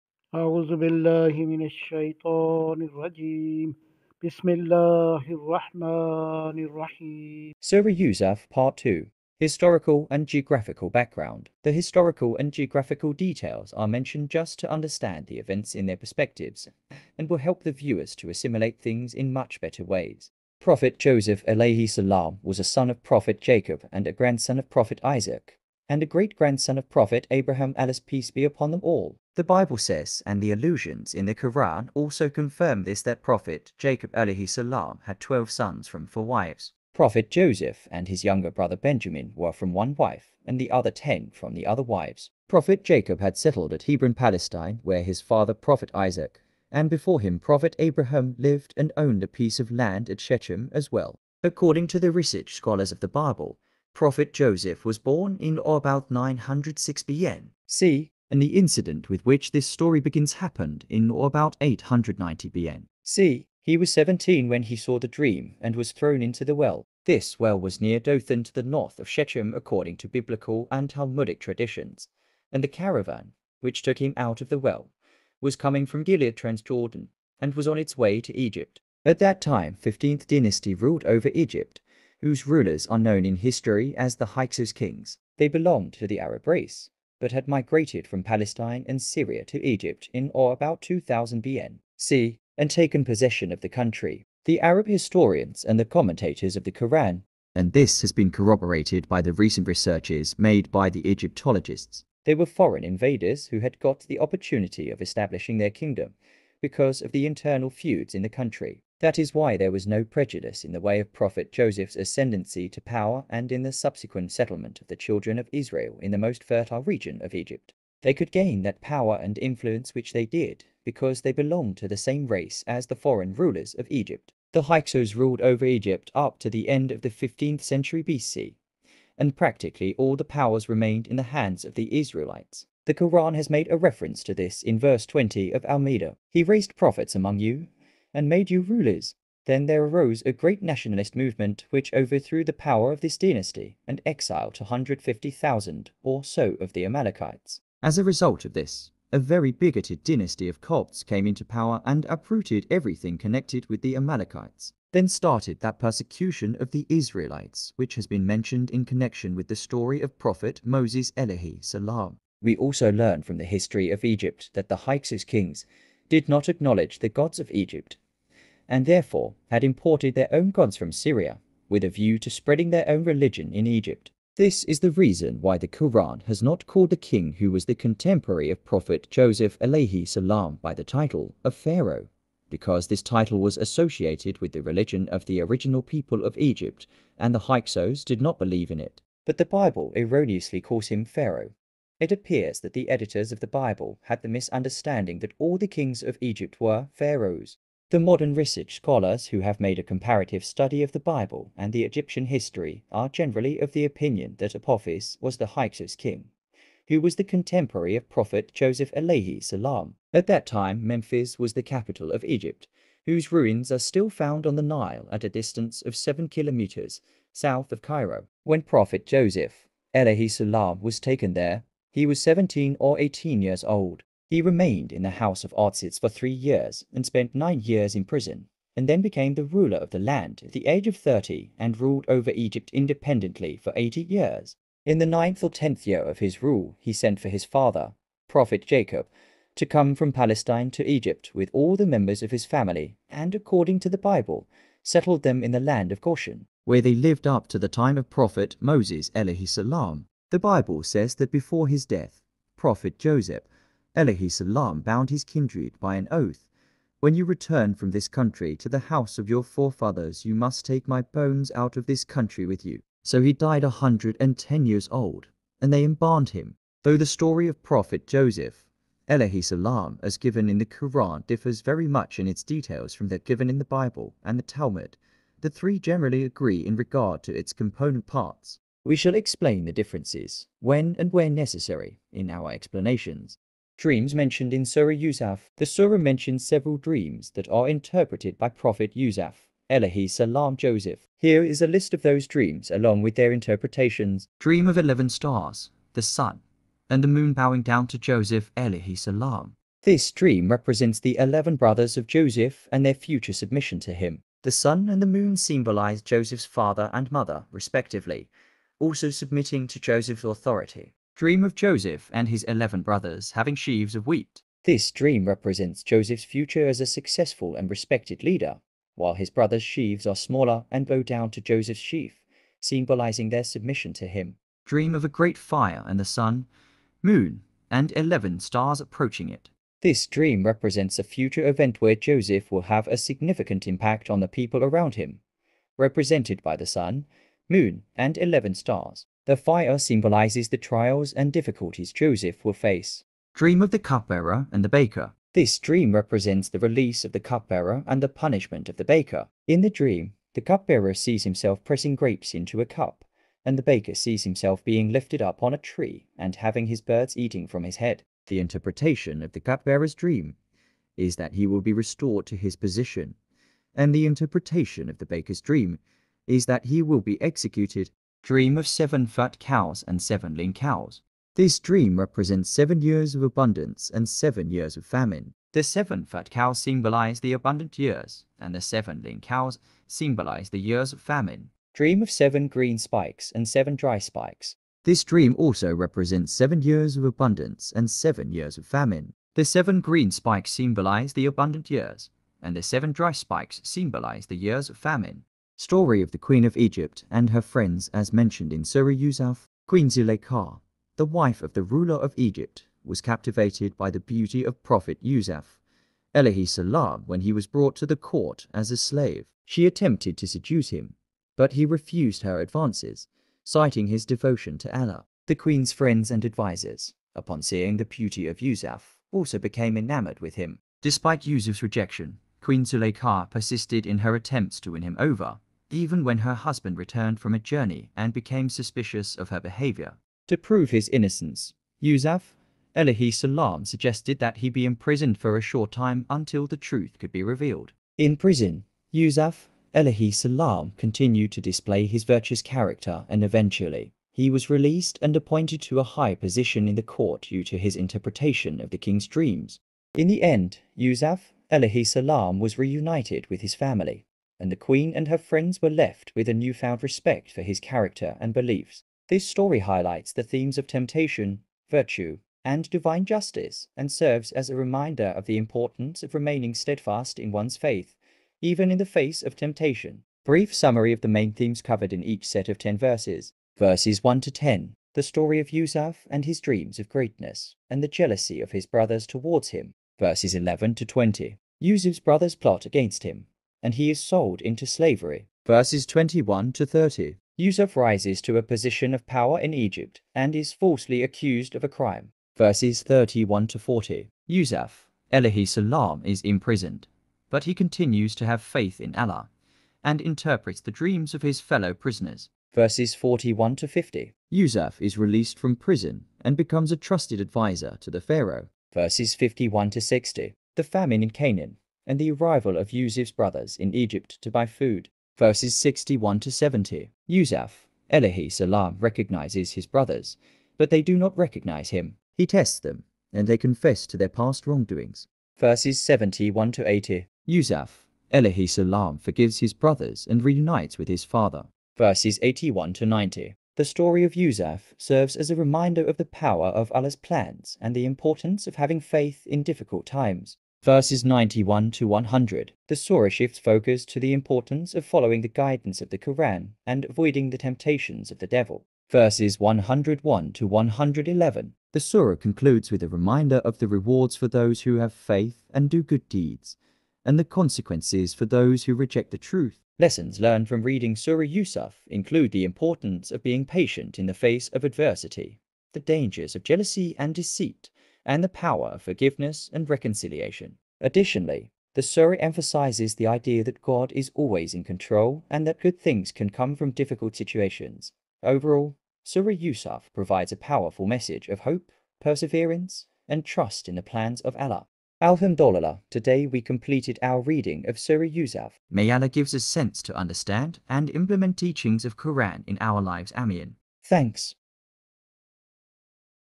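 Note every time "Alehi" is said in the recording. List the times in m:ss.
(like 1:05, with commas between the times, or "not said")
3:28, 3:39.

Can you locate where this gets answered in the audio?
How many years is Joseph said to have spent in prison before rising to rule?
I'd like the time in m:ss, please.
3:47.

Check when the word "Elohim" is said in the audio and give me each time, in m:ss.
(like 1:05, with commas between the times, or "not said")
4:13, 4:29.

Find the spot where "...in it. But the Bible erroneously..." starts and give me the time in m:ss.
3:08.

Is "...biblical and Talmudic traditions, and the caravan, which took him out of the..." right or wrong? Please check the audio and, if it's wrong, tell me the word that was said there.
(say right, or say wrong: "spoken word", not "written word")
right.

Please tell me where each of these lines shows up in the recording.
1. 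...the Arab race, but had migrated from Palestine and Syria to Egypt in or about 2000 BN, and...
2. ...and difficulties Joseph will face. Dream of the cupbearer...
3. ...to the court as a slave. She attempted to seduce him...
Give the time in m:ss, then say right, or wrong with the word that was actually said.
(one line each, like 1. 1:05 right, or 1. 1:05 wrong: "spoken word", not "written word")
1. 1:26 right
2. 5:41 right
3. 6:47 right.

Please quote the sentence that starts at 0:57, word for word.
See and the incident with which this story begins happened in or about 890 BN.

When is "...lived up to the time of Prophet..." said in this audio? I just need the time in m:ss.
4:06.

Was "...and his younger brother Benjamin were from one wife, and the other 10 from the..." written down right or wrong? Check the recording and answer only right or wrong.
right.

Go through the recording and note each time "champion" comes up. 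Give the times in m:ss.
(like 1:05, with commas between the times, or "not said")
not said.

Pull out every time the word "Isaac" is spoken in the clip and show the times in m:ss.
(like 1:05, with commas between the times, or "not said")
0:25, 0:45.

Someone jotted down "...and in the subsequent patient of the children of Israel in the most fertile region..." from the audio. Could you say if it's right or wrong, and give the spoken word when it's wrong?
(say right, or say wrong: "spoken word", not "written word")
wrong: "settlement", not "patient".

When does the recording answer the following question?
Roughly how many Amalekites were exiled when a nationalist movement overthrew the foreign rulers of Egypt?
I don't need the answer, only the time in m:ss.
2:24.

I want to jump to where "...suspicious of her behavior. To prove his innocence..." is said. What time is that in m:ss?
7:08.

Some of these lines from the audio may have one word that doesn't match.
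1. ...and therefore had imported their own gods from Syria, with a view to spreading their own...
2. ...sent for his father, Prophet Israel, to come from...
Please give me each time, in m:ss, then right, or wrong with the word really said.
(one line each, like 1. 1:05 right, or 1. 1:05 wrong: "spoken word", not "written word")
1. 2:48 right
2. 3:56 wrong: "Jacob", not "Israel".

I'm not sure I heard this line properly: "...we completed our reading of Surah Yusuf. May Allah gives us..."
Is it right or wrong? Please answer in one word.
right.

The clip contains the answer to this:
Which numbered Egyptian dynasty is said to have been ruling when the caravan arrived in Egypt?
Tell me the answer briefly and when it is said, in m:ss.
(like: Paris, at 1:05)
15th dynasty, at 1:19.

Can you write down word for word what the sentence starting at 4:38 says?
We shall explain the differences, when and where necessary, in our explanations.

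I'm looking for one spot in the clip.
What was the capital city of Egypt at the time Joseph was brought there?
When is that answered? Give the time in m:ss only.
3:30.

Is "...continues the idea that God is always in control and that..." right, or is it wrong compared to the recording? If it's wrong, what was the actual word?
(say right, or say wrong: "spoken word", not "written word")
wrong: "emphasizes", not "continues".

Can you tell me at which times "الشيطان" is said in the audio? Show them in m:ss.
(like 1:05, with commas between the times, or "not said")
0:01.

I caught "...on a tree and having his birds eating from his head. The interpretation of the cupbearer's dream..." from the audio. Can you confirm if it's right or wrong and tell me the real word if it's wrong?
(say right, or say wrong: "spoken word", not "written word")
right.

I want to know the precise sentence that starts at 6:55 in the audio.
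The queen's friends and advisers, upon seeing the beauty of Yusuf, also became enamored with him.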